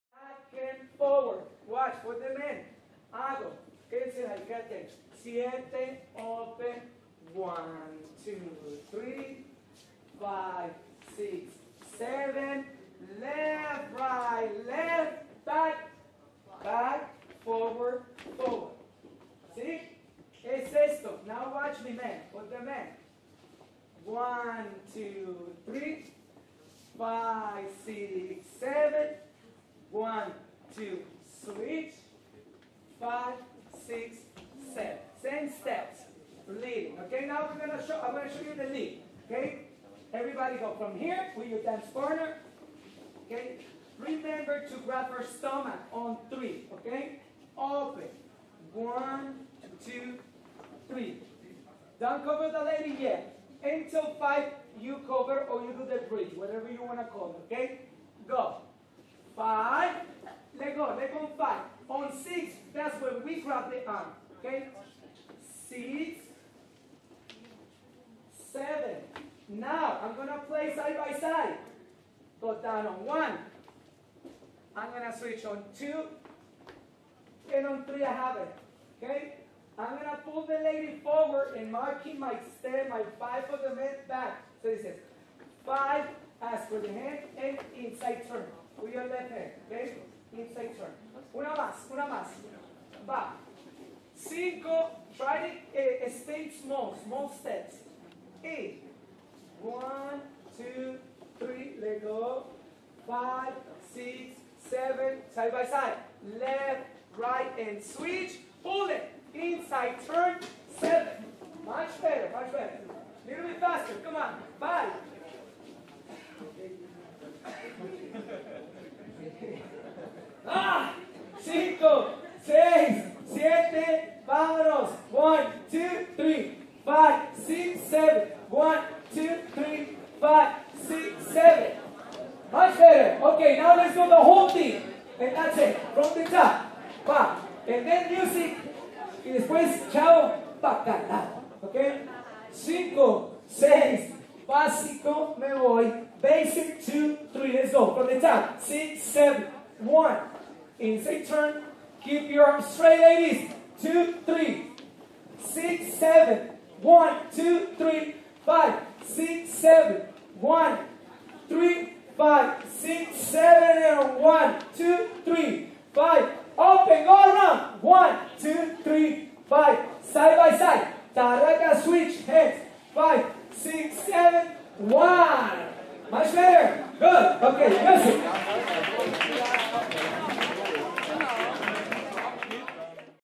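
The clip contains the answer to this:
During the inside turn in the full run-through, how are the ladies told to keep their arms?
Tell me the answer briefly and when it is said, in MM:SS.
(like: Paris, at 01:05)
straight, at 02:32.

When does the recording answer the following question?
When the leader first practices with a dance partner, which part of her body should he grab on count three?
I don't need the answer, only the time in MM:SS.
00:45.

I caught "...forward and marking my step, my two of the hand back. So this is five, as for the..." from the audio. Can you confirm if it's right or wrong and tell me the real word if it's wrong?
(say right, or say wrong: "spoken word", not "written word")
wrong: "five", not "two".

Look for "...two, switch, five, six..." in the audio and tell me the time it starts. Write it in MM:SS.
00:30.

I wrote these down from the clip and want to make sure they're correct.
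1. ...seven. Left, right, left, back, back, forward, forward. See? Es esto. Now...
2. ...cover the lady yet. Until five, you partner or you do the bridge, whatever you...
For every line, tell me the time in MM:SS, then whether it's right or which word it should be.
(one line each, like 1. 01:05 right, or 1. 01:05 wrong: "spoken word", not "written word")
1. 00:11 right
2. 00:52 wrong: "cover", not "partner".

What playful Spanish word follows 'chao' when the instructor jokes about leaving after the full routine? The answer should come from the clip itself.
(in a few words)
bacalao.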